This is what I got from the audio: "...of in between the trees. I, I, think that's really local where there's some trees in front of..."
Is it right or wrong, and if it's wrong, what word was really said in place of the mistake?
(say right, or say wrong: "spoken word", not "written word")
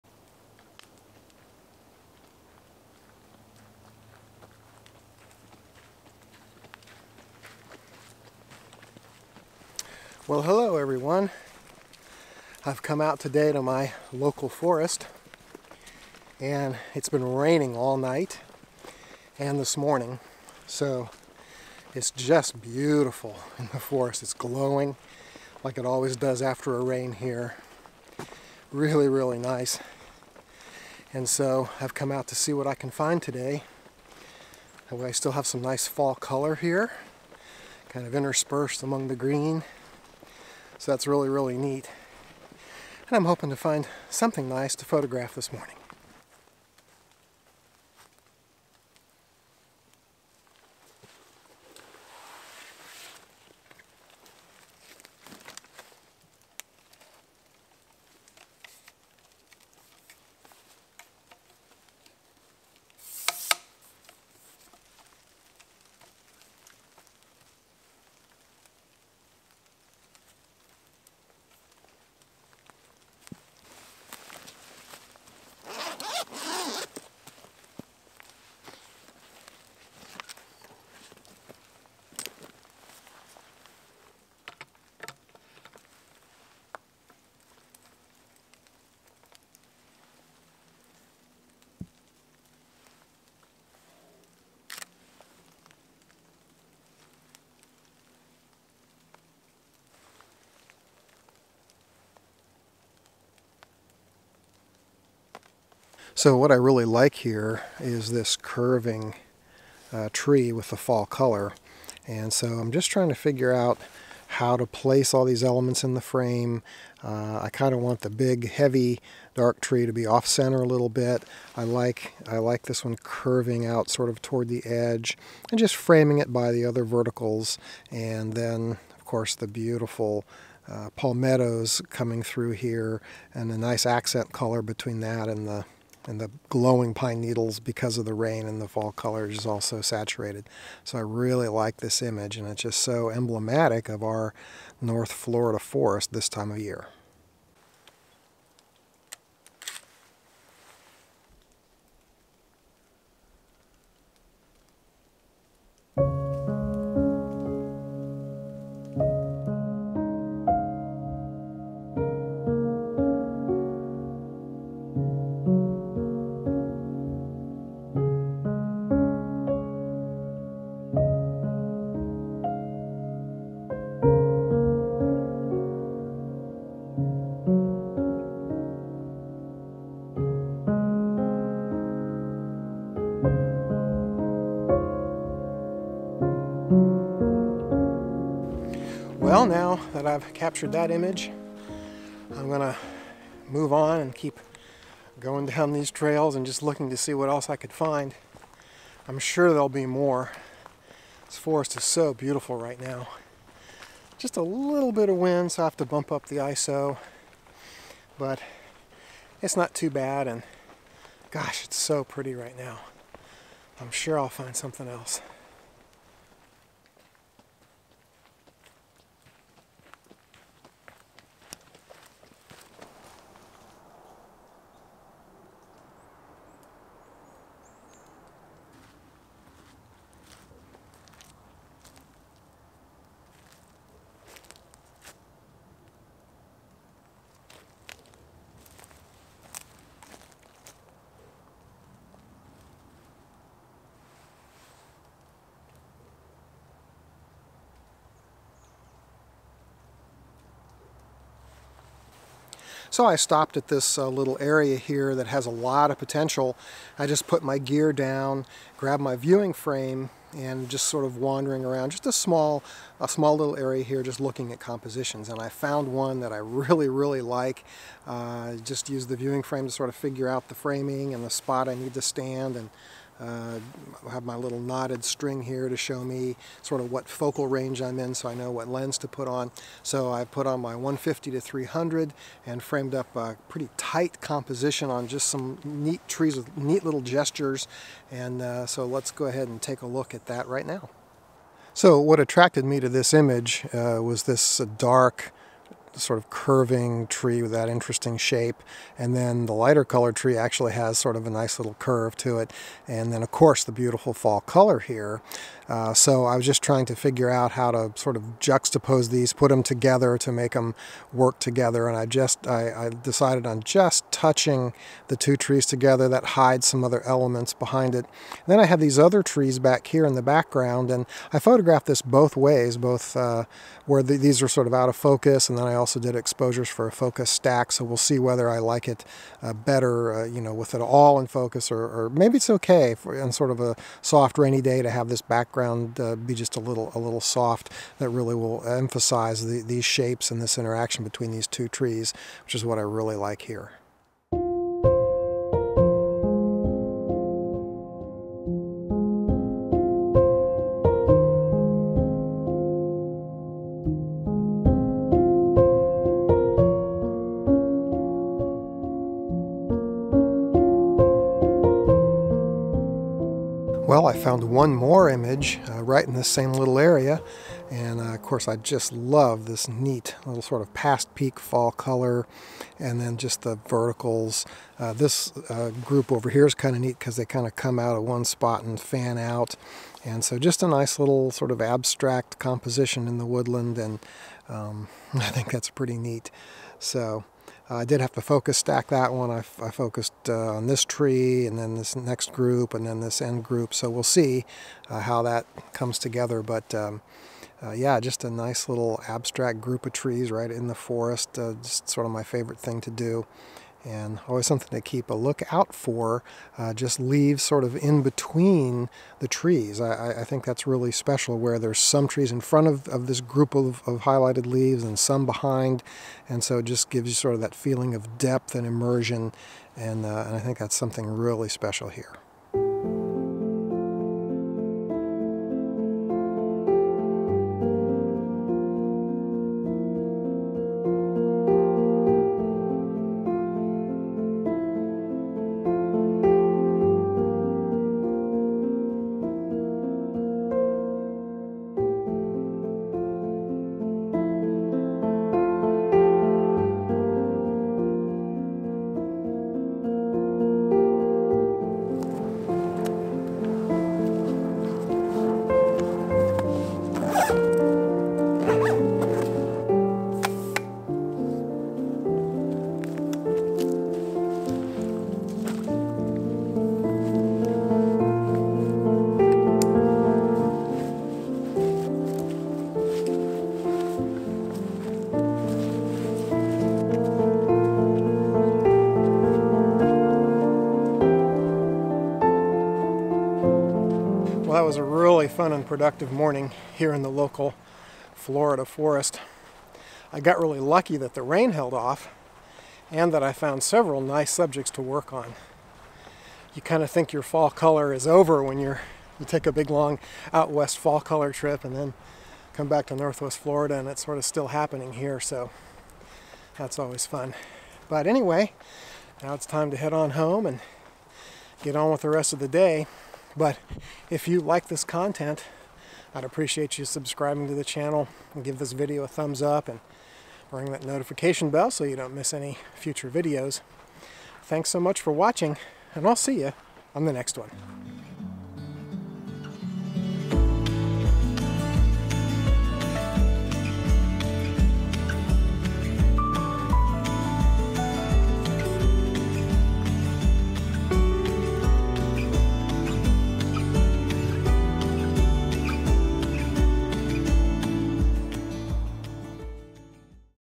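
wrong: "special", not "local".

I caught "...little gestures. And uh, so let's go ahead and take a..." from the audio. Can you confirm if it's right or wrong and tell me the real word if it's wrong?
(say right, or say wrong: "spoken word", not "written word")
right.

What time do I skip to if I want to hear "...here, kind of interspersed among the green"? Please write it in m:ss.
0:36.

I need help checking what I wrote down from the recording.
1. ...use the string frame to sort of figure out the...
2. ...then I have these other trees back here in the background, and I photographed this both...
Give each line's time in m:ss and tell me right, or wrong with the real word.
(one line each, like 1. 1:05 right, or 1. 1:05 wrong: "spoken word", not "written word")
1. 4:28 wrong: "viewing", not "string"
2. 5:18 right.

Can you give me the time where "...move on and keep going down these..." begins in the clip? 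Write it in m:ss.
3:13.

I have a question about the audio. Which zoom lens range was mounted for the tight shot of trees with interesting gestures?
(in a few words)
150 to 300.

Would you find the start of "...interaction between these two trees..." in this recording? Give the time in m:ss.
5:40.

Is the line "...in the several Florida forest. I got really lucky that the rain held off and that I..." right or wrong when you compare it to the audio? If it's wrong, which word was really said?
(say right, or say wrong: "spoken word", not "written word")
wrong: "local", not "several".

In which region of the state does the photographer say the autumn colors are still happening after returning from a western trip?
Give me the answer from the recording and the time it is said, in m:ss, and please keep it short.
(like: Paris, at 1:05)
Northwest Florida, at 8:22.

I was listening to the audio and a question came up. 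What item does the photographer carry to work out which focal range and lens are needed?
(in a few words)
Knotted string.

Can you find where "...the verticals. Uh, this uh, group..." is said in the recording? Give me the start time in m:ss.
6:13.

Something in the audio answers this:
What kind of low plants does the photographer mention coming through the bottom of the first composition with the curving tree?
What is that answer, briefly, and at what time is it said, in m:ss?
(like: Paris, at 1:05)
Palmettos, at 2:10.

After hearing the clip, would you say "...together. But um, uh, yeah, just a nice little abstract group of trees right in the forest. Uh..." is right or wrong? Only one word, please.
right.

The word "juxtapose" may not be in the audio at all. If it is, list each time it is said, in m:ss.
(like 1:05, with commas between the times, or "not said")
5:08.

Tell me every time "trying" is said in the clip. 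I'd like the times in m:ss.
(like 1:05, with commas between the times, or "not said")
1:52, 5:06.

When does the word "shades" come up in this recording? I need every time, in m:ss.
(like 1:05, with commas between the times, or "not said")
not said.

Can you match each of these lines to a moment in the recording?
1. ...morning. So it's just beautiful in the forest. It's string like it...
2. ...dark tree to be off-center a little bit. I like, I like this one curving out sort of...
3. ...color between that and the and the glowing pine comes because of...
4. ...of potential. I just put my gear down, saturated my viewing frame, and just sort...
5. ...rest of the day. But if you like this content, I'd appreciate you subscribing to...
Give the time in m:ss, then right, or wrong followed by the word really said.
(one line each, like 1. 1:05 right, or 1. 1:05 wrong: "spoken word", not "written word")
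1. 0:19 wrong: "glowing", not "string"
2. 1:59 right
3. 2:14 wrong: "needles", not "comes"
4. 4:15 wrong: "grabbed", not "saturated"
5. 8:32 right.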